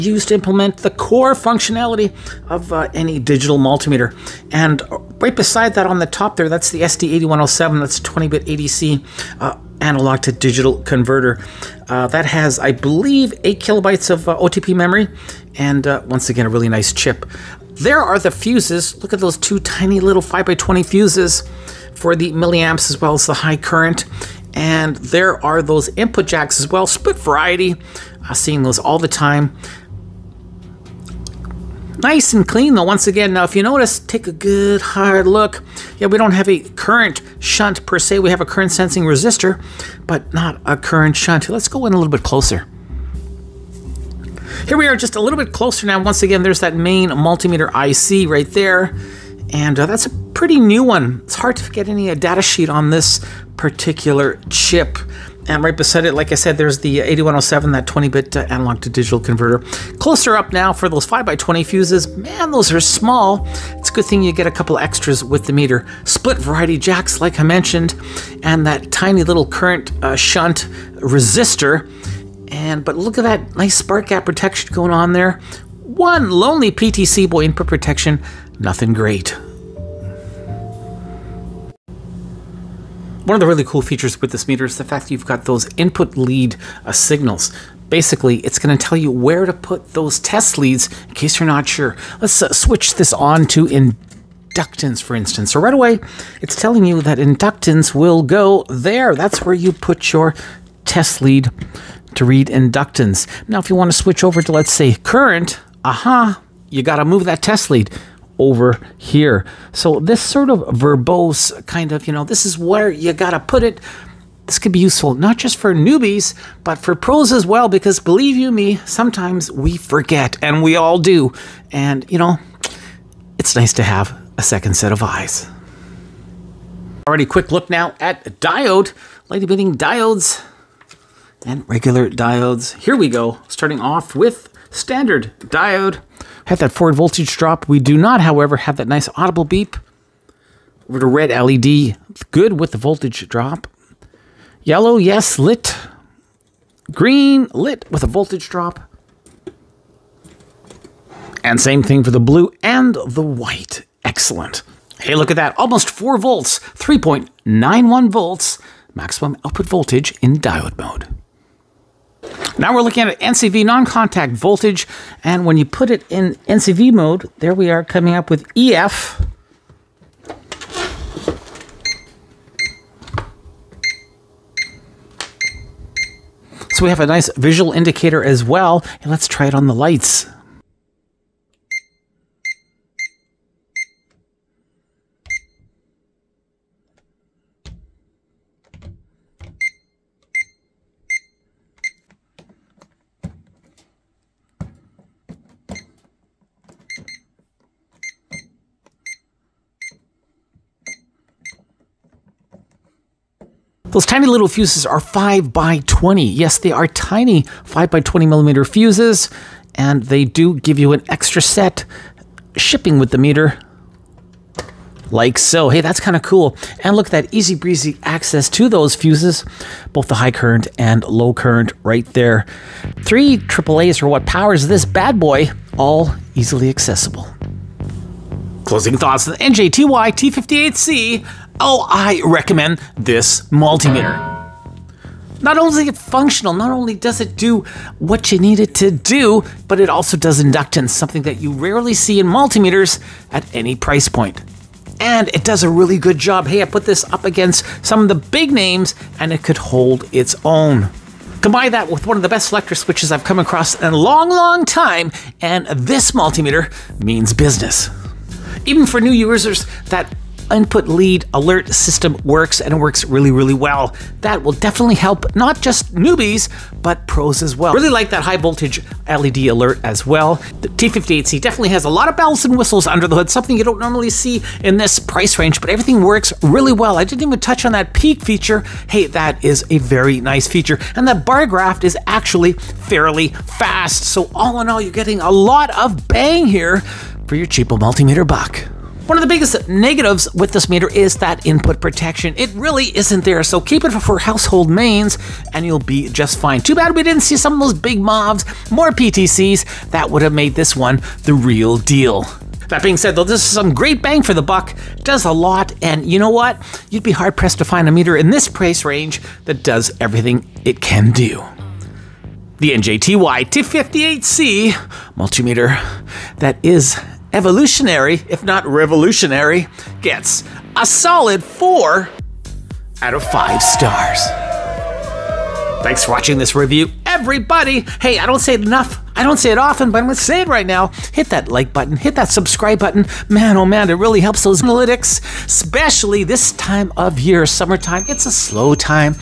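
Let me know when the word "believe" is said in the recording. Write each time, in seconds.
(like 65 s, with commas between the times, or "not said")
12 s, 117 s.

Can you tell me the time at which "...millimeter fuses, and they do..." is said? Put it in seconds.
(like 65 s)
208 s.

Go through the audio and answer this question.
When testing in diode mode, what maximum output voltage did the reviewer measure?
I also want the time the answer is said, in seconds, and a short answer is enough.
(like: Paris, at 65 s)
3.91 volts, at 156 s.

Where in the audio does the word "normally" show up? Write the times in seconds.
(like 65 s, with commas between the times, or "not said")
273 s.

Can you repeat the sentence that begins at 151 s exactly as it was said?
And same thing for the blue and the white.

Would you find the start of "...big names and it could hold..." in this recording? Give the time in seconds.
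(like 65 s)
248 s.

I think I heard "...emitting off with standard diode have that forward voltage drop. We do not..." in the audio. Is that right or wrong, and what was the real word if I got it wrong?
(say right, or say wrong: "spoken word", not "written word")
wrong: "starting", not "emitting".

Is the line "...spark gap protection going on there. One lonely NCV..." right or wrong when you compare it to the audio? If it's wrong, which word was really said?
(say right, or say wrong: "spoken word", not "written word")
wrong: "PTC", not "NCV".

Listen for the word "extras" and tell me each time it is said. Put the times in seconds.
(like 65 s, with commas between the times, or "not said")
64 s, 211 s.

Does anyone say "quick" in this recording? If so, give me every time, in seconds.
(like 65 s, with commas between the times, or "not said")
127 s.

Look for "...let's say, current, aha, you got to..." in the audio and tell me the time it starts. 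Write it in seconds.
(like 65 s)
104 s.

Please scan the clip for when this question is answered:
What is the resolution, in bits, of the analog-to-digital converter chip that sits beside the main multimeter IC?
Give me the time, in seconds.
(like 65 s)
8 s.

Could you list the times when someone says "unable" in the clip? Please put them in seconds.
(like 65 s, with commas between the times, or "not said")
not said.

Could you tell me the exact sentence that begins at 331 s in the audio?
Hit that like button, hit that subscribe button.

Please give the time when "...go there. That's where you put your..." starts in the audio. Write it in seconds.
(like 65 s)
98 s.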